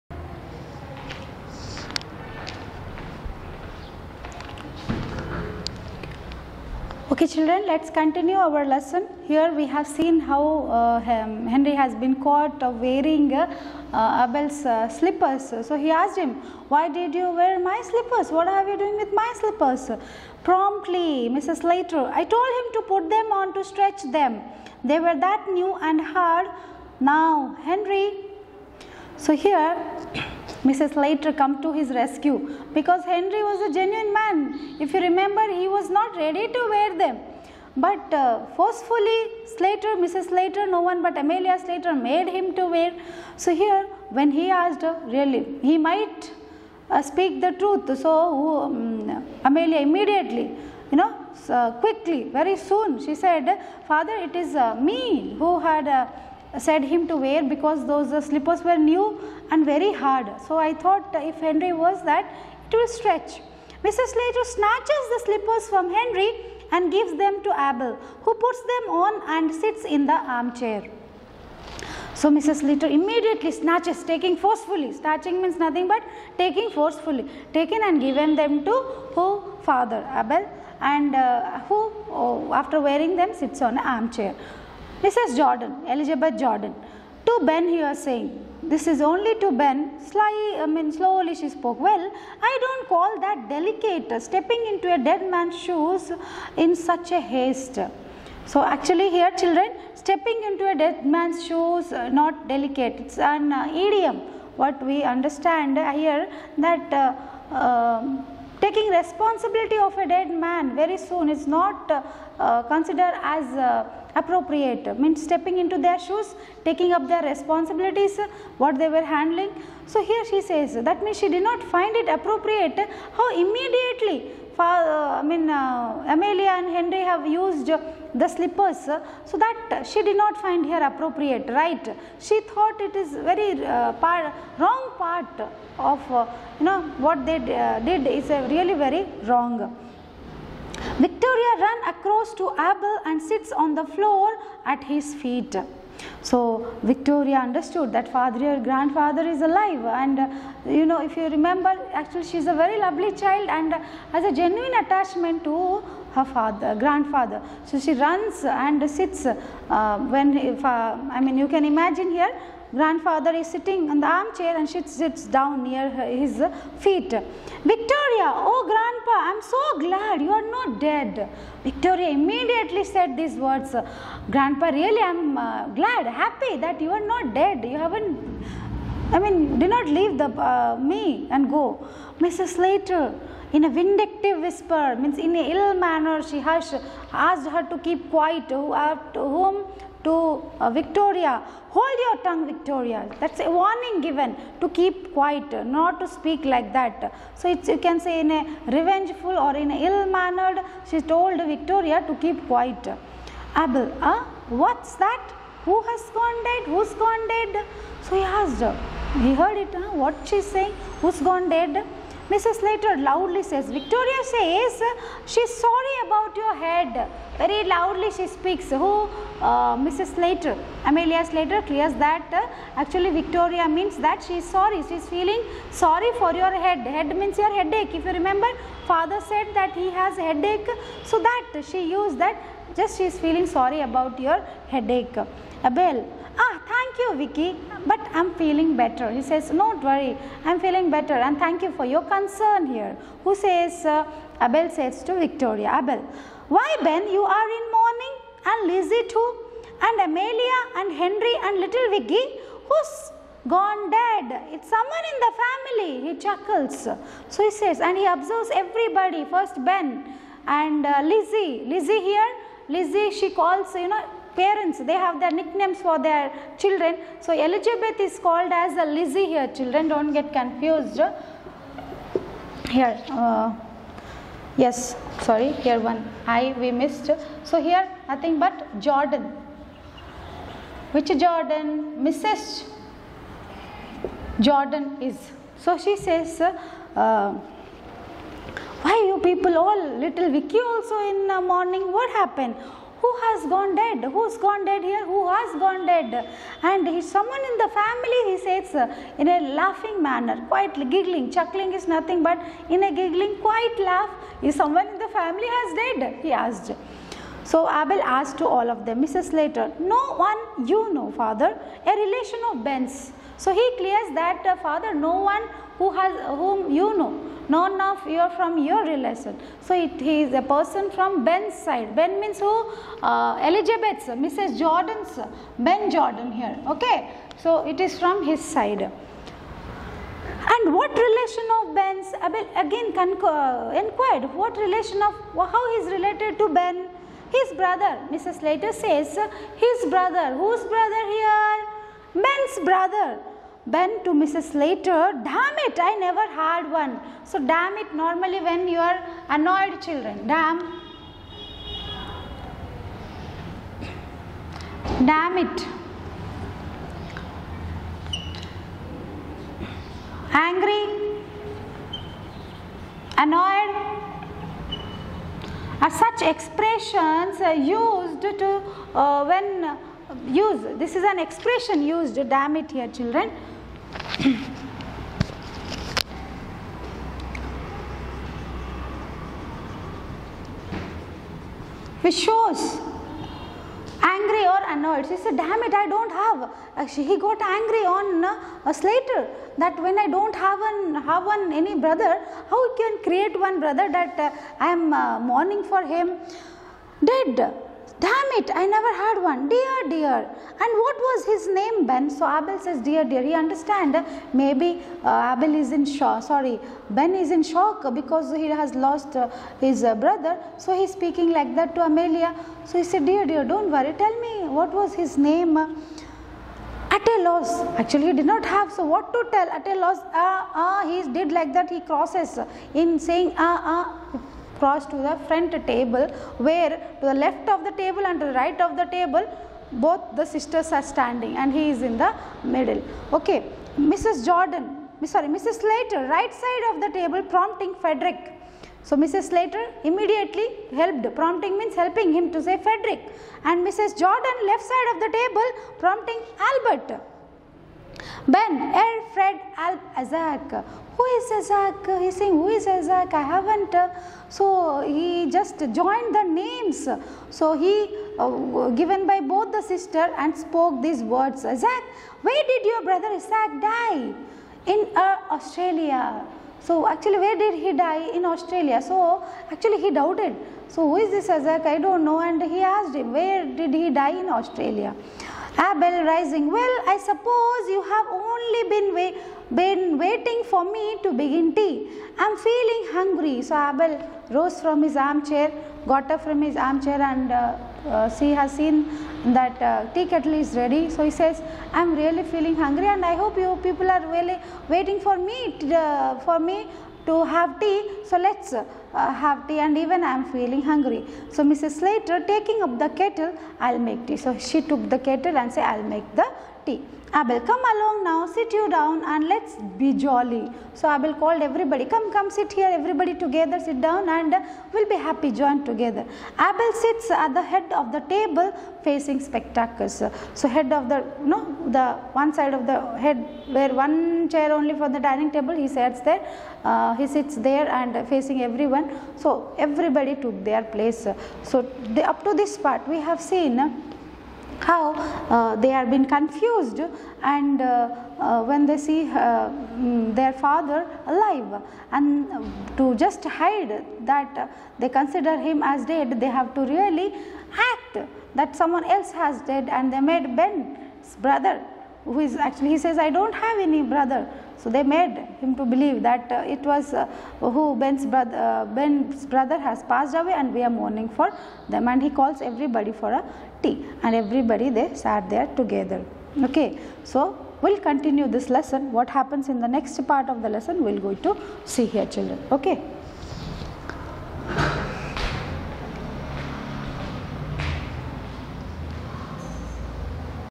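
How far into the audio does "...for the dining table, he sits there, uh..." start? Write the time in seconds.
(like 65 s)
524 s.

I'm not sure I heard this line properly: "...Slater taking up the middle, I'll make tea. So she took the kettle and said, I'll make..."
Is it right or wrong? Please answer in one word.
wrong.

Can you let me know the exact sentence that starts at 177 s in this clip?
You haven't, I mean, do not leave the uh, me and go.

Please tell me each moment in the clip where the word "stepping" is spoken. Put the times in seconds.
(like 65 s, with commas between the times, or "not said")
94 s, 99 s, 115 s.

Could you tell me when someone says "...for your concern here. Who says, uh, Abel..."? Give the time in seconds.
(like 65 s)
241 s.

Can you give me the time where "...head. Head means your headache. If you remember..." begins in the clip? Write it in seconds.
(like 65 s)
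226 s.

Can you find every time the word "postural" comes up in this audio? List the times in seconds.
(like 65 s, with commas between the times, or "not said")
not said.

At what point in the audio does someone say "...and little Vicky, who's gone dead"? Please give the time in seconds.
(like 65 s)
251 s.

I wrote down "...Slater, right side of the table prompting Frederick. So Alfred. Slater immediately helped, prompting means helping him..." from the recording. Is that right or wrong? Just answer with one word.
wrong.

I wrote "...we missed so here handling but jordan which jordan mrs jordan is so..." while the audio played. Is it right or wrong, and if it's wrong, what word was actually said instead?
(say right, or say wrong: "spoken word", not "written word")
wrong: "nothing", not "handling".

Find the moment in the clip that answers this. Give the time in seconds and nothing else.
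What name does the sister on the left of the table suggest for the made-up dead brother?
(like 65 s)
445 s.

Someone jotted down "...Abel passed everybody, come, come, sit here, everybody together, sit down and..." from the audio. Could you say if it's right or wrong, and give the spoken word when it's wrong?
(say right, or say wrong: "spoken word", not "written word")
wrong: "called", not "passed".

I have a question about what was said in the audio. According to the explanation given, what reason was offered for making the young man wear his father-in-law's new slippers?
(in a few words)
To stretch them.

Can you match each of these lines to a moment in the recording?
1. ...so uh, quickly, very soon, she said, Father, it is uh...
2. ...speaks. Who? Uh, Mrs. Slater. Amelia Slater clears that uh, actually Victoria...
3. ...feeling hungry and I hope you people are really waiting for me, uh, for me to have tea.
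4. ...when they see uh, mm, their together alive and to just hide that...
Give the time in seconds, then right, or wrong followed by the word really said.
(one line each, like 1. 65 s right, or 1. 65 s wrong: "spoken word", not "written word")
1. 51 s right
2. 218 s right
3. 492 s right
4. 538 s wrong: "father", not "together".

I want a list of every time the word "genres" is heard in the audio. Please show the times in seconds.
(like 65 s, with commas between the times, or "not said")
not said.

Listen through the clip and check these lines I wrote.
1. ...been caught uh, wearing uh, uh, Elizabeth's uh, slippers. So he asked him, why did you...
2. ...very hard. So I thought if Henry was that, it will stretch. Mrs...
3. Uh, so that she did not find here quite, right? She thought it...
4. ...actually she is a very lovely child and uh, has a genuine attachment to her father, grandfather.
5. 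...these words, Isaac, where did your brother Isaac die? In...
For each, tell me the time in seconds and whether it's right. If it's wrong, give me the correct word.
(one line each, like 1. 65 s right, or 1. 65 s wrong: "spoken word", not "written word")
1. 11 s wrong: "Abel", not "Elizabeth"
2. 59 s right
3. 128 s wrong: "appropriate", not "quite"
4. 151 s right
5. 460 s right.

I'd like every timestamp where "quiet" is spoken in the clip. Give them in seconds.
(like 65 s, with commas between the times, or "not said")
188 s, 195 s, 202 s, 303 s.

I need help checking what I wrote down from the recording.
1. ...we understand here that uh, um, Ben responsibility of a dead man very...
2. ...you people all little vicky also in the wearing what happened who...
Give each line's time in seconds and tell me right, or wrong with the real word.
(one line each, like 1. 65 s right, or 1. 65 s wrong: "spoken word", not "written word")
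1. 104 s wrong: "Taking", not "Ben"
2. 289 s wrong: "mourning", not "wearing".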